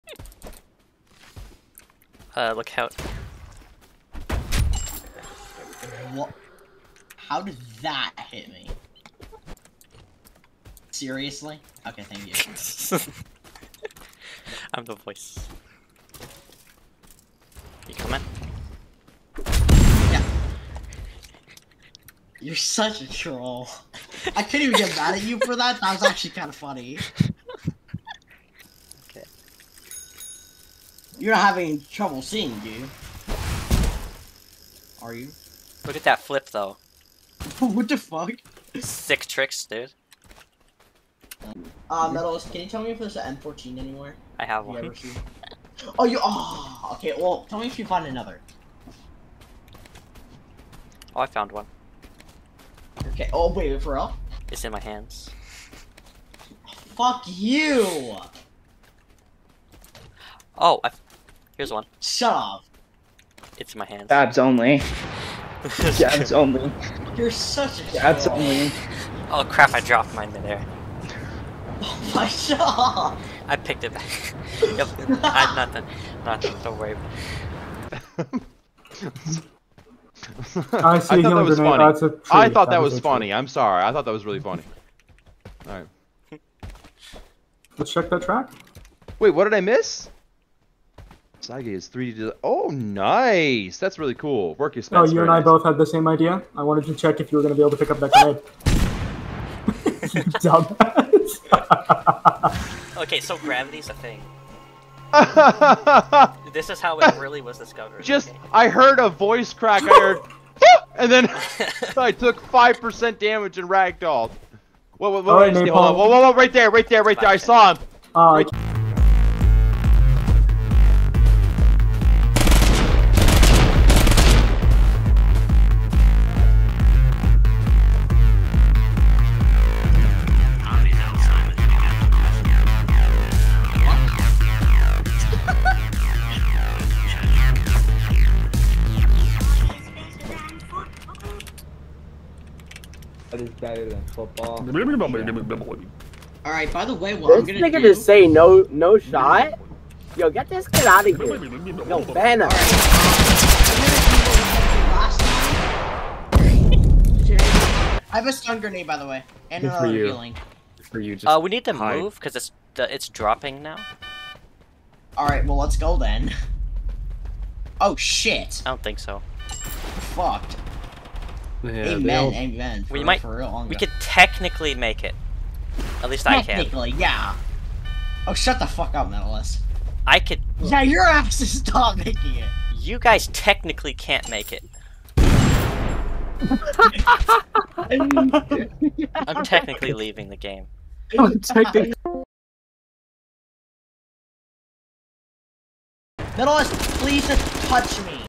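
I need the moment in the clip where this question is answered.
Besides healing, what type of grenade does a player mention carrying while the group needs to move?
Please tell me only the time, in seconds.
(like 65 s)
158 s.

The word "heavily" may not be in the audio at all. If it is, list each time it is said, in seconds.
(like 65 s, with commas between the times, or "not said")
not said.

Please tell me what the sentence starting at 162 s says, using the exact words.
move because it's it's dropping now.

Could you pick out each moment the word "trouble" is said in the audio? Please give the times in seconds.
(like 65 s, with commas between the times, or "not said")
31 s.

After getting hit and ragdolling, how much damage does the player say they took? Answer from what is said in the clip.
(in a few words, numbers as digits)
5%.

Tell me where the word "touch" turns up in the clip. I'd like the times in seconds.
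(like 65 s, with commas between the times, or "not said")
197 s.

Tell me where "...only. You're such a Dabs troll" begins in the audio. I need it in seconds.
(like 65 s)
66 s.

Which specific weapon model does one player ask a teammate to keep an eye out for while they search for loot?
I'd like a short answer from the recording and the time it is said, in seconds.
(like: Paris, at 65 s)
M14, at 43 s.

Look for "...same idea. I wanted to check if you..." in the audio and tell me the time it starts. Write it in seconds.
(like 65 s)
95 s.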